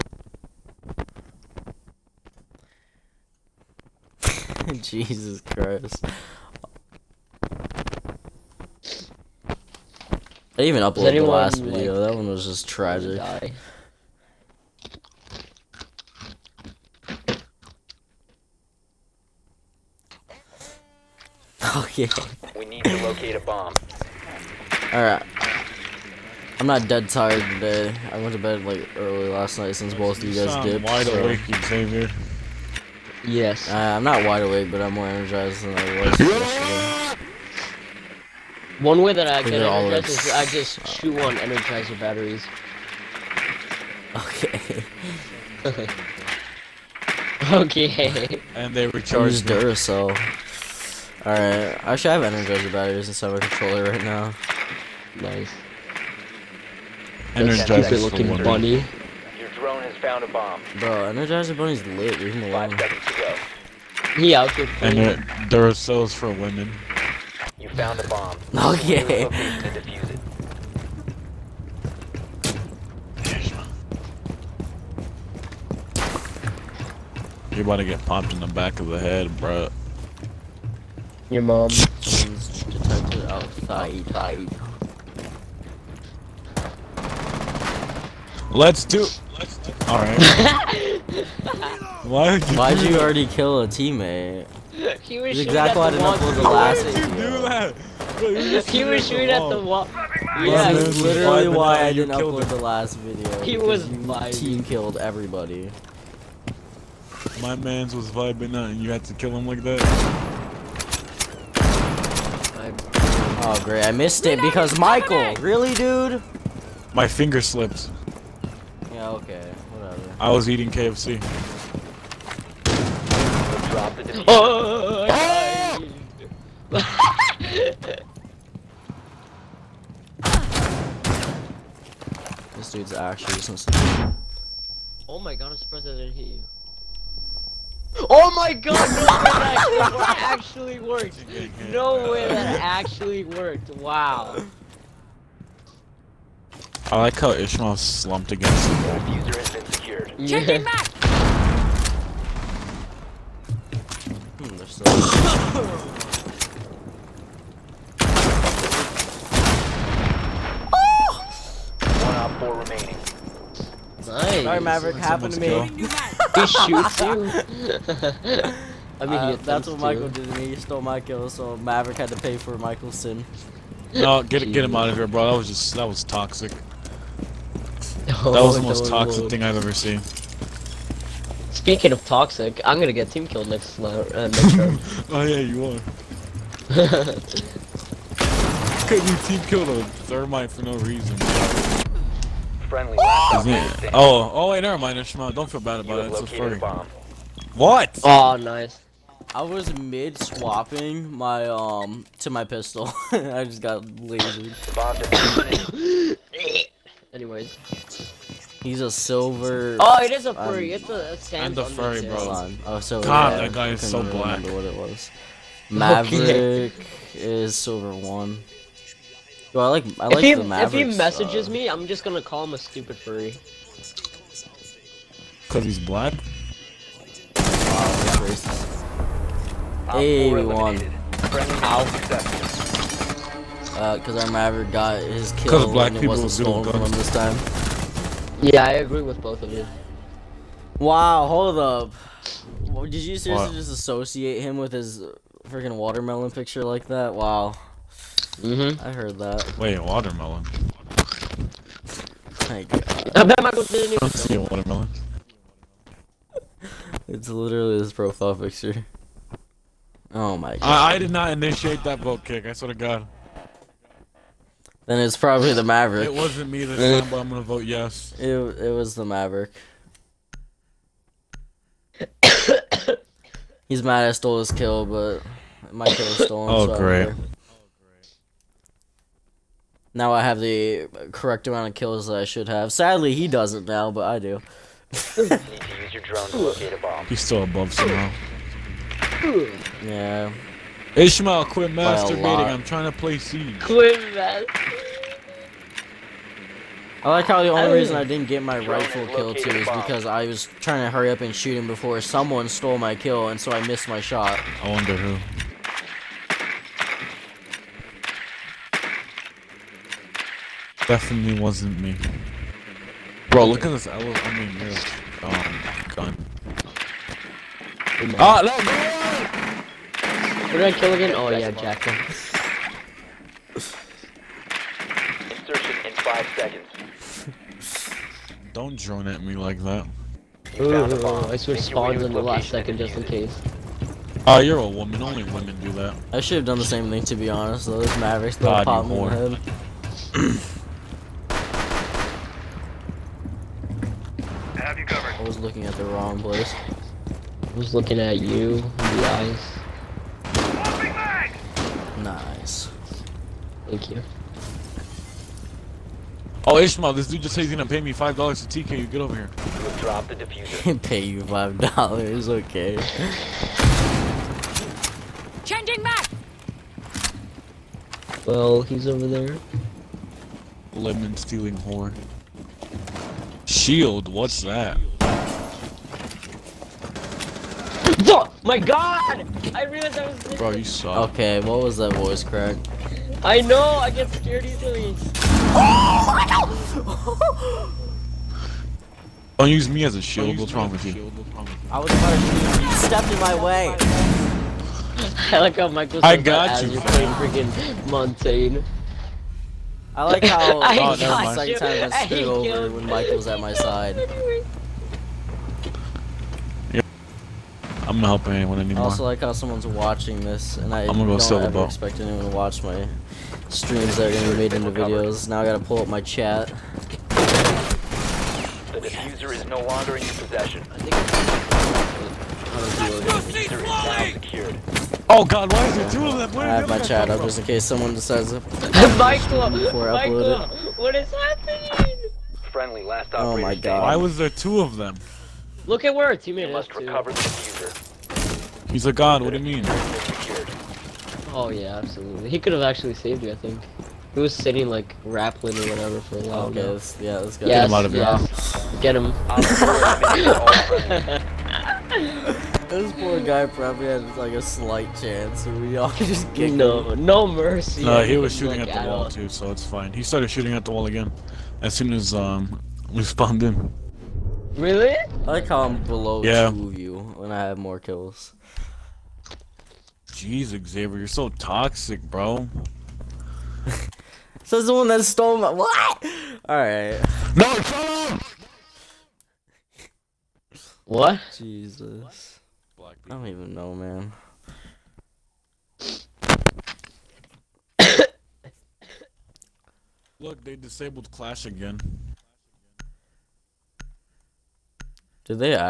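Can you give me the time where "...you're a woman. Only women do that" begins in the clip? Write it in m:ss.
5:34.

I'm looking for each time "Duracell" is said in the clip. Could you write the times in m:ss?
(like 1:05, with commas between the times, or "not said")
0:49.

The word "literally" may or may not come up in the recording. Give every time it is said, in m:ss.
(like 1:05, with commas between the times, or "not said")
1:40, 4:17.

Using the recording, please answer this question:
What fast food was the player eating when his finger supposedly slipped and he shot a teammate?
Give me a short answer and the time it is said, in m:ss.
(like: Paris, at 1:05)
KFC, at 2:00.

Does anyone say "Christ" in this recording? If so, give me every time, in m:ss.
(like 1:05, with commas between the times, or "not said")
0:05.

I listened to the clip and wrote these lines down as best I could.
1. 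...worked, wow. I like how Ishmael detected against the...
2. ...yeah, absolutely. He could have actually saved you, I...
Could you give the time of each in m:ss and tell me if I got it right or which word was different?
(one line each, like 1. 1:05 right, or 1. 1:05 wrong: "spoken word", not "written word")
1. 2:23 wrong: "slumped", not "detected"
2. 7:21 right.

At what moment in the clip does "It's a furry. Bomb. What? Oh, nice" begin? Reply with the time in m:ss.
3:16.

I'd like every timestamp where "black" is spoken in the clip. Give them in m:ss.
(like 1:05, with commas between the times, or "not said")
3:34, 3:45, 3:55.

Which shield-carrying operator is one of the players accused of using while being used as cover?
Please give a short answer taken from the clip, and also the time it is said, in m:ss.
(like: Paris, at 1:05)
Montagne, at 6:37.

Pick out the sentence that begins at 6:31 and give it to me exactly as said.
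I was about to stepped in my way.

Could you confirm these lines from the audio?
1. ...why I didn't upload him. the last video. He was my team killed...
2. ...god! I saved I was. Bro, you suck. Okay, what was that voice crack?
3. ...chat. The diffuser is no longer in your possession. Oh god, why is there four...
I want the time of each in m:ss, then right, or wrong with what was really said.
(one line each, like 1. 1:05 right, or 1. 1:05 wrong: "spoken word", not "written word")
1. 1:41 right
2. 6:18 wrong: "realized", not "saved"
3. 6:55 wrong: "two", not "four".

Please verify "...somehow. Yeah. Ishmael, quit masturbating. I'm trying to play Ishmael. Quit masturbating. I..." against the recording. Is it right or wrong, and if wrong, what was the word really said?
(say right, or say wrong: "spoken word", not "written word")
wrong: "Siege", not "Ishmael".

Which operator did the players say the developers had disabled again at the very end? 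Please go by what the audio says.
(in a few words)
Clash.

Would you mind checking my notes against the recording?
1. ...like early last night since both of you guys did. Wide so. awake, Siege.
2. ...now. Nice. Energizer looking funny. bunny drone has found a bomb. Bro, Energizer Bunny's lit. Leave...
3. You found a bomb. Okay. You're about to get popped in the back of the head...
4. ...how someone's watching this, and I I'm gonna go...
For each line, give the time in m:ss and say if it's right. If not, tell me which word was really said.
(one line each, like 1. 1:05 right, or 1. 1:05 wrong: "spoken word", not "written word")
1. 0:28 wrong: "Xavier", not "Siege"
2. 0:54 right
3. 1:07 right
4. 6:49 right.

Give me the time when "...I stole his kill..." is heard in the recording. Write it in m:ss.
4:34.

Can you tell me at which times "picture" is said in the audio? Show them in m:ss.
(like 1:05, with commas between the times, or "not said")
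4:06, 4:18.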